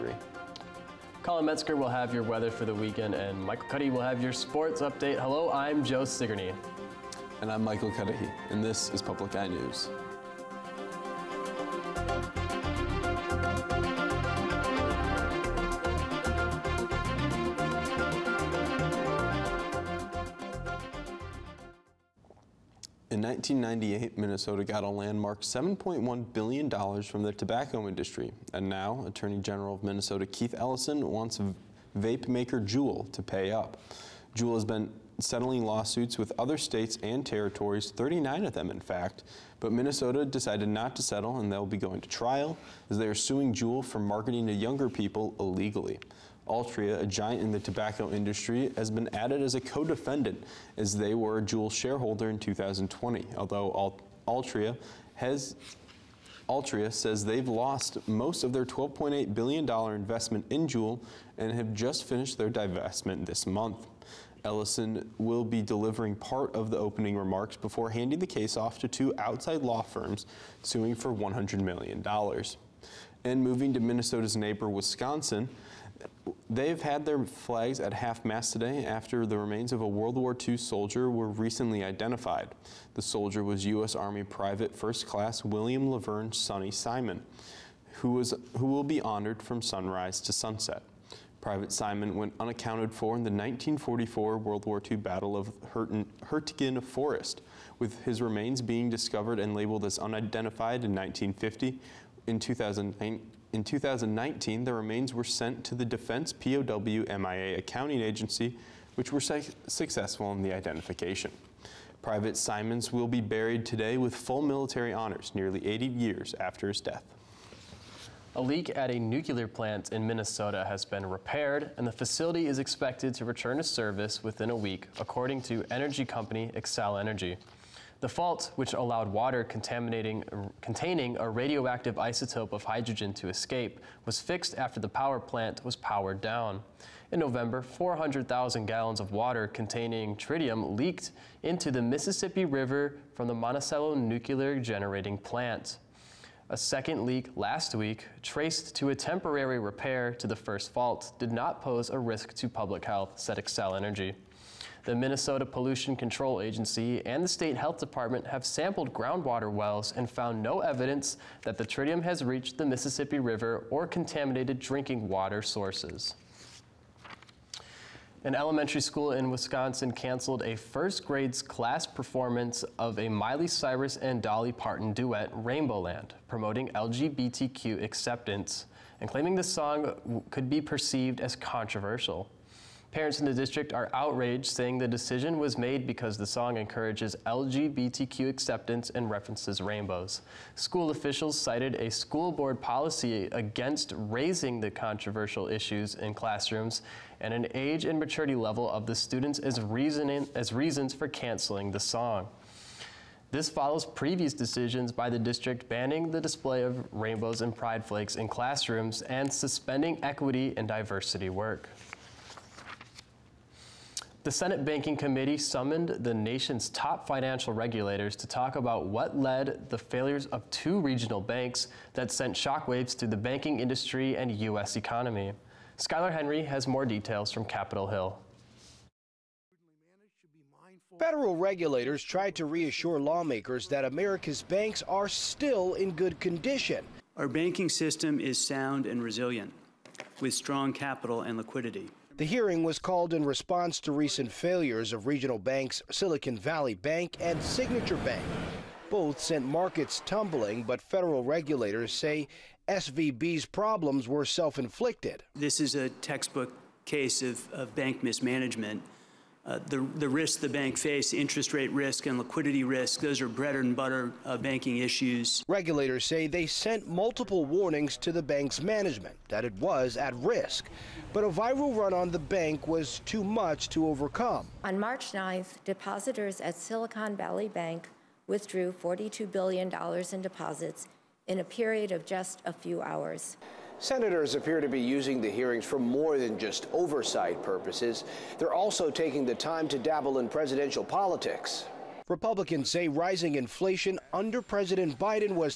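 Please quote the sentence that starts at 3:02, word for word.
Parents in the district are outraged, saying the decision was made because the song encourages LGBTQ acceptance and references rainbows.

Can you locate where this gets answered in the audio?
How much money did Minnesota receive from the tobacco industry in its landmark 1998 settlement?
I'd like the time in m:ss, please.
0:25.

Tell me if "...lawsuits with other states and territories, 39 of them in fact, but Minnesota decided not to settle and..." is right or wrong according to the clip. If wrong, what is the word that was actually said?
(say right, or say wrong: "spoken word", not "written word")
right.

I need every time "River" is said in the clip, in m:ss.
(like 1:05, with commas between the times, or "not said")
2:22, 2:43.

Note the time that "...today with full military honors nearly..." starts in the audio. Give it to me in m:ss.
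1:53.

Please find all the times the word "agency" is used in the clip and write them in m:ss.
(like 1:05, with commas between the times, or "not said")
1:48, 2:36.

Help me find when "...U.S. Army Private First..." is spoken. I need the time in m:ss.
1:23.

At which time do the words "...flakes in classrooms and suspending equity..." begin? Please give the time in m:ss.
3:27.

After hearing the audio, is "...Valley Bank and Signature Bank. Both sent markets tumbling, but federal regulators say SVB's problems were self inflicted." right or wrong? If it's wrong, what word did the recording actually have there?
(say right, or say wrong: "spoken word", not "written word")
right.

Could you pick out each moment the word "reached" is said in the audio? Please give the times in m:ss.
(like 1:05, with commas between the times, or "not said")
2:42.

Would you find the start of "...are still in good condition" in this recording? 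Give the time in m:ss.
3:54.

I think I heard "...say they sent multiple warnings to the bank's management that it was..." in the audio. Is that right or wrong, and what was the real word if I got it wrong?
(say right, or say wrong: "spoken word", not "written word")
right.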